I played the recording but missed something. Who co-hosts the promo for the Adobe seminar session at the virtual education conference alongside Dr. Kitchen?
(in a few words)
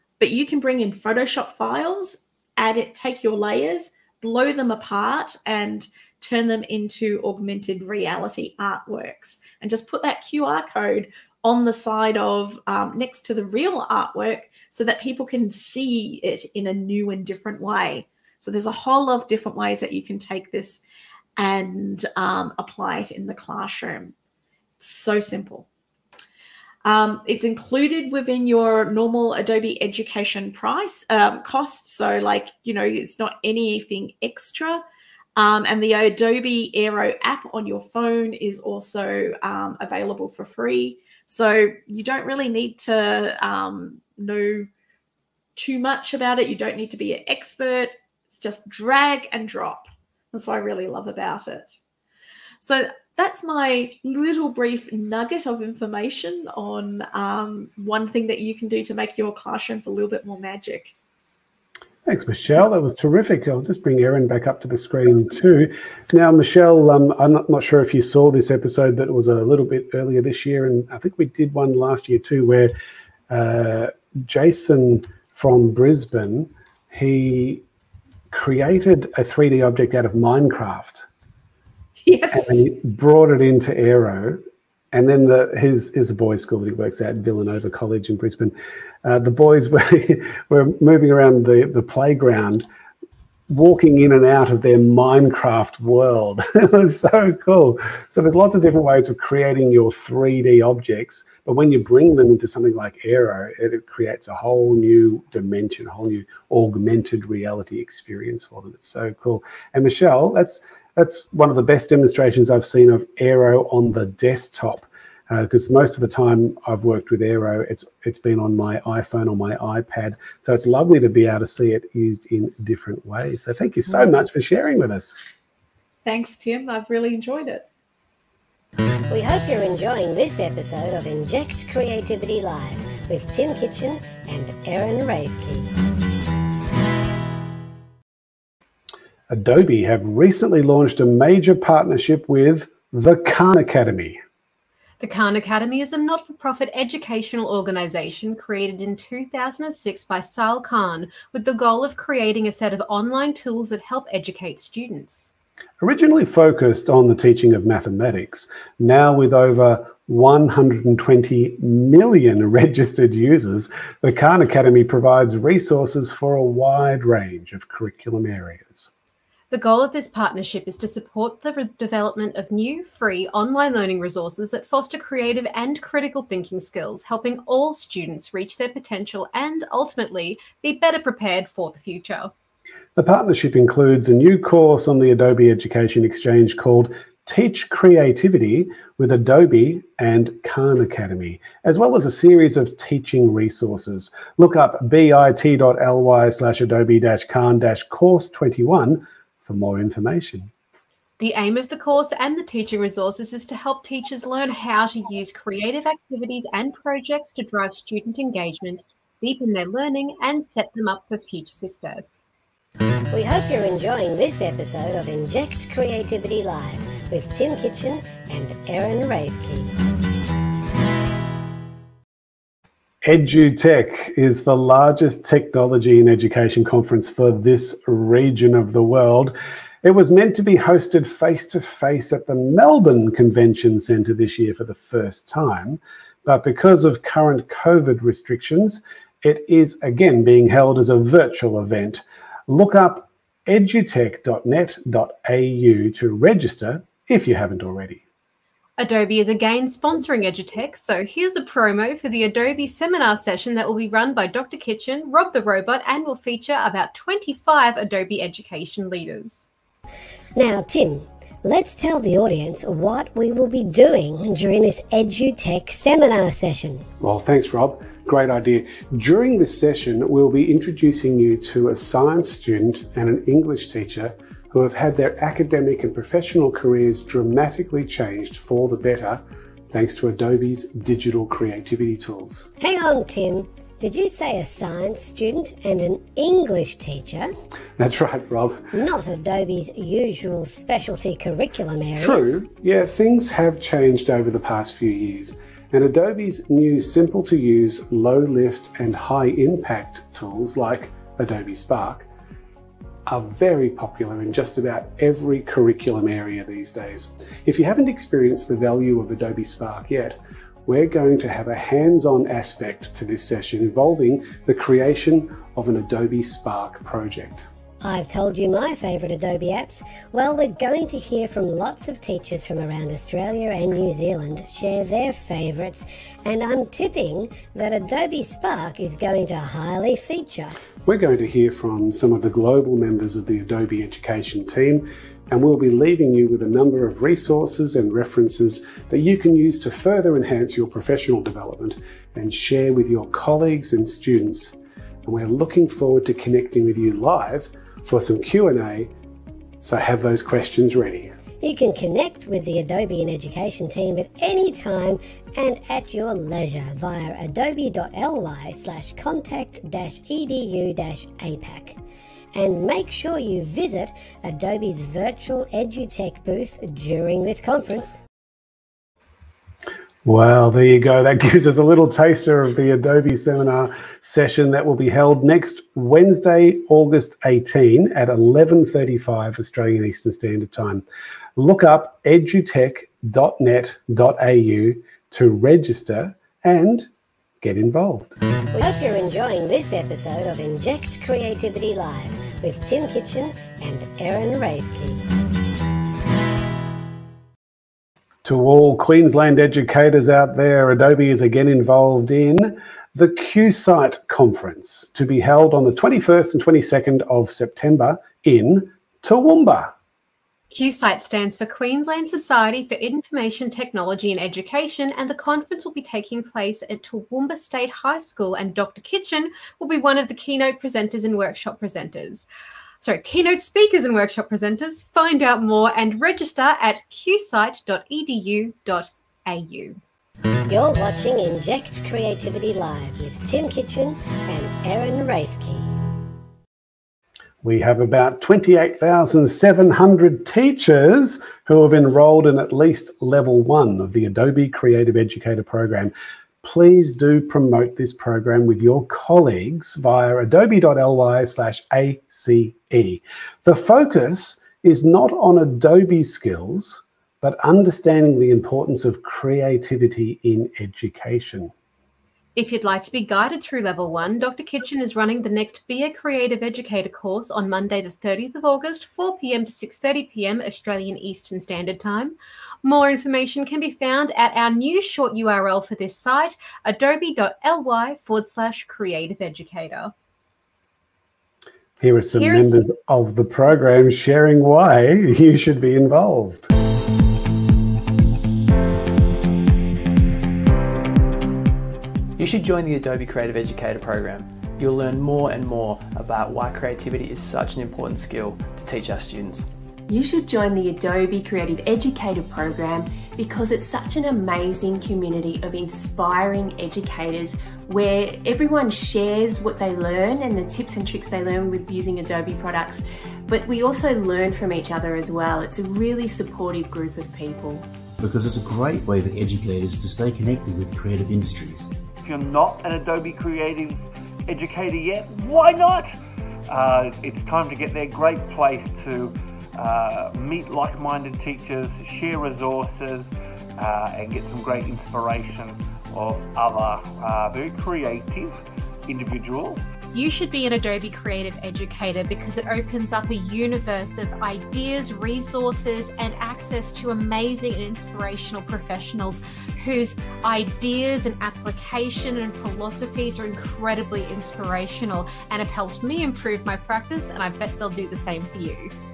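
Rob the Robot.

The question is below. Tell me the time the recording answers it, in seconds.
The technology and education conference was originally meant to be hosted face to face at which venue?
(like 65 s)
232 s.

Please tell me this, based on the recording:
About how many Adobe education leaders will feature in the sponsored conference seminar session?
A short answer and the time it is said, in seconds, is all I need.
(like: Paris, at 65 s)
25, at 256 s.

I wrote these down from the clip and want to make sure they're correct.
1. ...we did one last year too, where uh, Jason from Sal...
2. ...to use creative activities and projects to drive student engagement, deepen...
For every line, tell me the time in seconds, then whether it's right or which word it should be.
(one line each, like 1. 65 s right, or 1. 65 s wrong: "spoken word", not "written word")
1. 71 s wrong: "Brisbane", not "Sal"
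2. 204 s right.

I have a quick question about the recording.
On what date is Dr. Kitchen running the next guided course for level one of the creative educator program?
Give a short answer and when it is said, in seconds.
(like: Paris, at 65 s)
30 August, at 467 s.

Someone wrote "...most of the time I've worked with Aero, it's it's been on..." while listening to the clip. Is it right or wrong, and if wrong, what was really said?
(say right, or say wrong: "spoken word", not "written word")
right.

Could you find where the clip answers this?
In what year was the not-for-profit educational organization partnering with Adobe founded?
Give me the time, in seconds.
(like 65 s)
148 s.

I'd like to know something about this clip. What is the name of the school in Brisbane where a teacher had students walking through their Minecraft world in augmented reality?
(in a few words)
Villanova College.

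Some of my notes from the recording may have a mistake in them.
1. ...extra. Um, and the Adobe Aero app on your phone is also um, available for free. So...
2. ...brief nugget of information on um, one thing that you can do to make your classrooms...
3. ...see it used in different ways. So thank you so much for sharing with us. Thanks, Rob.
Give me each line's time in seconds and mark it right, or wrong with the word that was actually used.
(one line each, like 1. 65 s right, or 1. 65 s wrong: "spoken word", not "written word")
1. 34 s right
2. 54 s right
3. 121 s wrong: "Tim", not "Rob".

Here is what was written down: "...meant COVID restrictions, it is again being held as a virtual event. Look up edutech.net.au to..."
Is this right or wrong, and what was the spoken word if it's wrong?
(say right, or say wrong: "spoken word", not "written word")
wrong: "current", not "meant".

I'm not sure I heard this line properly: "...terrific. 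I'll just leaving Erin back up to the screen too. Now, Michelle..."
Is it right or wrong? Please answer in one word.
wrong.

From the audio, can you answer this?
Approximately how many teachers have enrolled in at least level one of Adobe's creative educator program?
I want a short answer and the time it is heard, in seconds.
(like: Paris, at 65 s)
28,700, at 438 s.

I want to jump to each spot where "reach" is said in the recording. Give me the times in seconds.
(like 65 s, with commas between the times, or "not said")
178 s.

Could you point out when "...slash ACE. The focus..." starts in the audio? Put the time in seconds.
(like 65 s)
451 s.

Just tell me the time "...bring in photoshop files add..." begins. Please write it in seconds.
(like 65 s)
0 s.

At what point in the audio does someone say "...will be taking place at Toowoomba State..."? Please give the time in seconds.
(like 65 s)
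415 s.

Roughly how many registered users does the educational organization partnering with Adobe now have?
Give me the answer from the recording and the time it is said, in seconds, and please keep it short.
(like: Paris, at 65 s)
120 million, at 160 s.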